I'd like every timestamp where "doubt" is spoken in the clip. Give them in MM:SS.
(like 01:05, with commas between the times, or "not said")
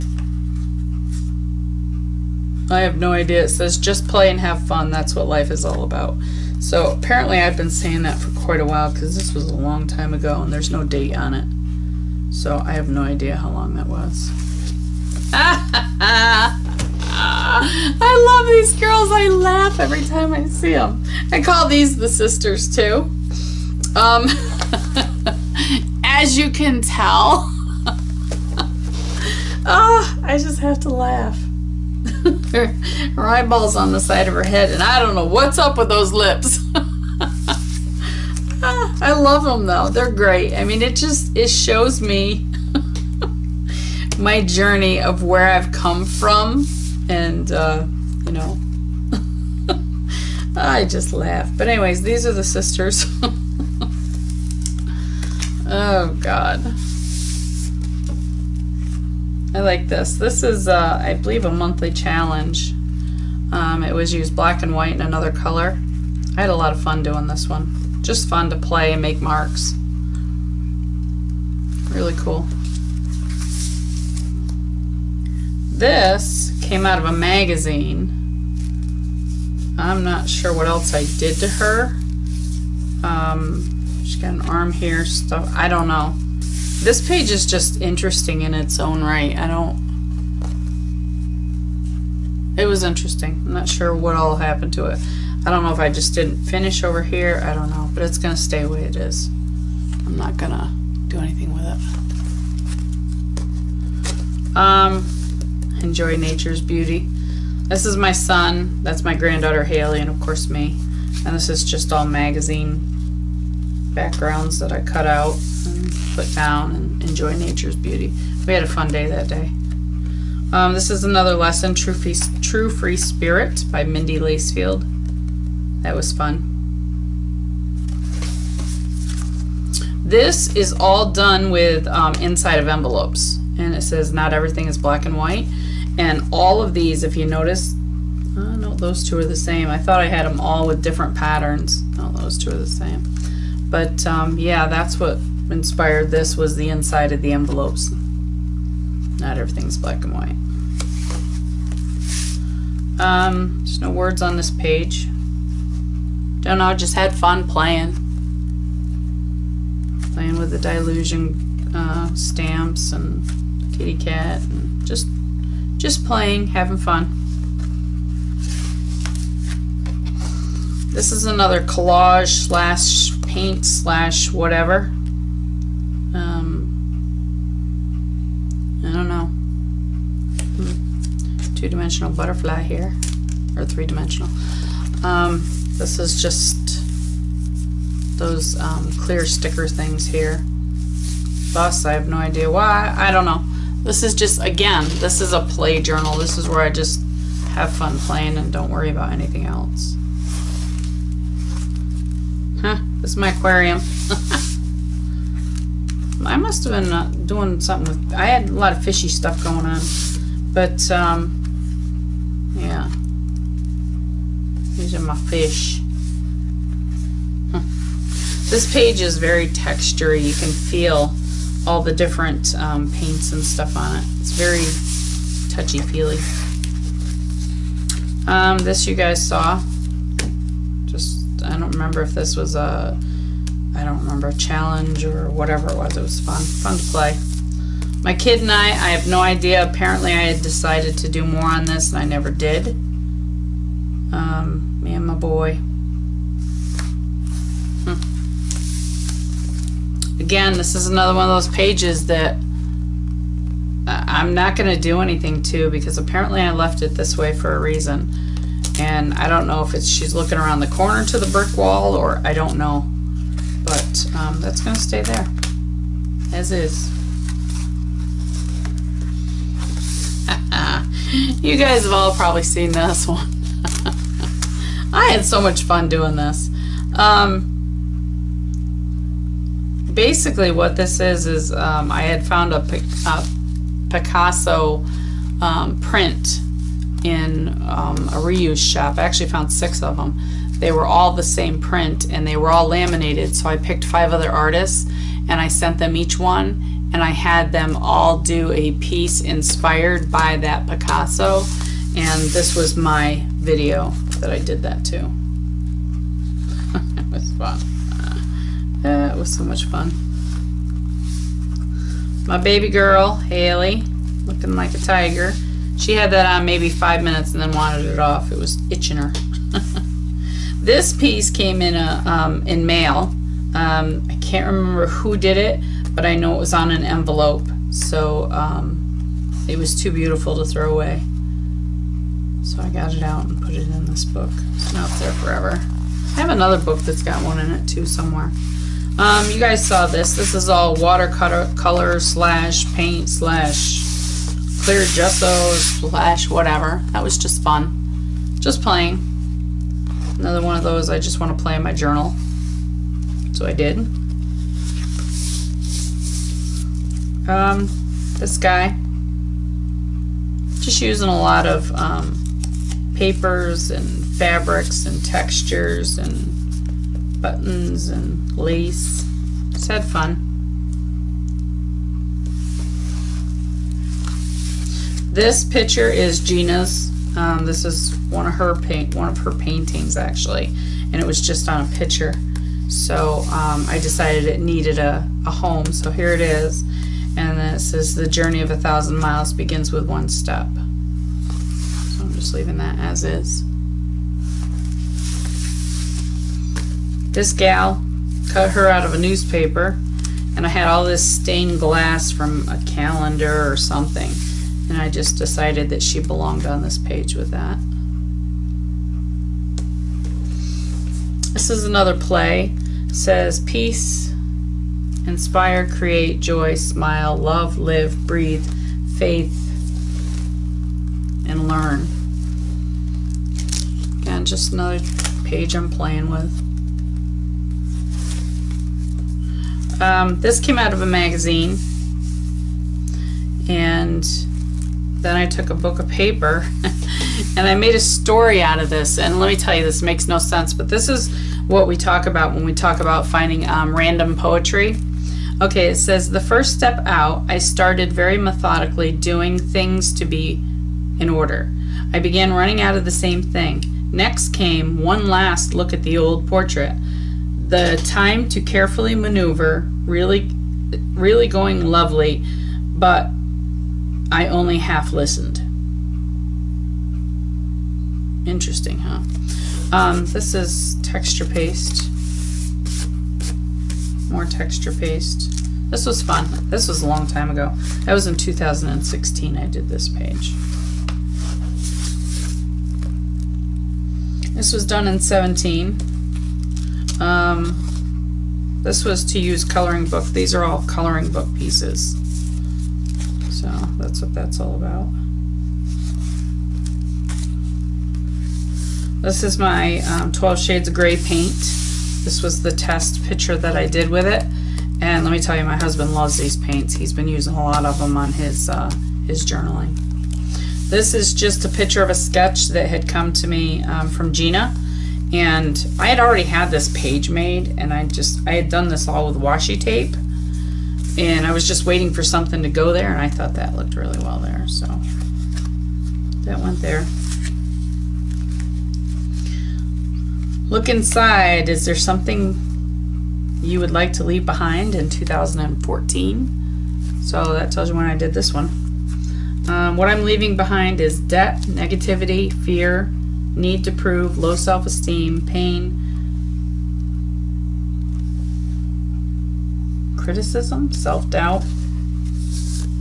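09:10.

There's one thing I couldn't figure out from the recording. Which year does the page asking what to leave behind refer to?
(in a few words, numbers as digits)
2014.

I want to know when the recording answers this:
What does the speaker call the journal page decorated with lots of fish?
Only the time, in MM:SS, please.
03:23.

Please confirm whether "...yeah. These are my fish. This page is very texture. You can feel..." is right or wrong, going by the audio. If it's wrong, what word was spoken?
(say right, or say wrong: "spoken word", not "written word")
right.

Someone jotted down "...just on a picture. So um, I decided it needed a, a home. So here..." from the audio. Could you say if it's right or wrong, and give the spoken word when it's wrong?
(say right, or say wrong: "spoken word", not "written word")
right.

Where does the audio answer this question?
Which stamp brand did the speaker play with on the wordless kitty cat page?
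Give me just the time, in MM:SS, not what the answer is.
02:40.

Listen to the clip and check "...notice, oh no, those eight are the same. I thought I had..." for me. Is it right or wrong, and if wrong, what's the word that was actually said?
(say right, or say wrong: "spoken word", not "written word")
wrong: "two", not "eight".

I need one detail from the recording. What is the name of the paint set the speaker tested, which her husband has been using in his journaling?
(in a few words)
12 Shades of Gray.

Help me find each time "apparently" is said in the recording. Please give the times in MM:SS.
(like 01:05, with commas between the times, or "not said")
00:06, 03:59, 04:15.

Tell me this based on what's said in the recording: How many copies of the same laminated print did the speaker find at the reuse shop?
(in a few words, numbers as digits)
6.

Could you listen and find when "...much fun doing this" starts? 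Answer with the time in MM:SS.
04:35.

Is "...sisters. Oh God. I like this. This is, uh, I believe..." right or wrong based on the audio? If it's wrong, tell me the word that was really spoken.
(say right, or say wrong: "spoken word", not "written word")
right.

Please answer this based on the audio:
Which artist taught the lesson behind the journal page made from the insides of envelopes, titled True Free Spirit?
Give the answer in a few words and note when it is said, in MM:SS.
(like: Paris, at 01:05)
Mindy Lacefield, at 02:03.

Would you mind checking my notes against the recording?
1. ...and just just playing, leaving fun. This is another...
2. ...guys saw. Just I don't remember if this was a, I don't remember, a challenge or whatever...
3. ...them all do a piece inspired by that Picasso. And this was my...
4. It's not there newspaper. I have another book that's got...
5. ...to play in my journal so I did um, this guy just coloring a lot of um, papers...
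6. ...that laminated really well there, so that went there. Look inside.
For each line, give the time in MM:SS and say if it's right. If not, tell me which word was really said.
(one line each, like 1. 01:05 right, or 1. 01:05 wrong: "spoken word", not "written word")
1. 02:44 wrong: "having", not "leaving"
2. 03:48 right
3. 04:57 right
4. 05:34 wrong: "forever", not "newspaper"
5. 05:51 wrong: "using", not "coloring"
6. 08:43 wrong: "looked", not "laminated".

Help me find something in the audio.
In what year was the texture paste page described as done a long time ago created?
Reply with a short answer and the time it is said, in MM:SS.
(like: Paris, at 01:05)
2016, at 07:58.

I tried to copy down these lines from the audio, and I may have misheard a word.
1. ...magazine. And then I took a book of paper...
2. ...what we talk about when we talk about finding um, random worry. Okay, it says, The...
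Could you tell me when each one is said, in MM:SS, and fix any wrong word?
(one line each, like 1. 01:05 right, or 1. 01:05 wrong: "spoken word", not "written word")
1. 07:10 right
2. 07:21 wrong: "poetry", not "worry".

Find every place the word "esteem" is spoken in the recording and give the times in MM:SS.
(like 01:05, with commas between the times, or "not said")
09:04.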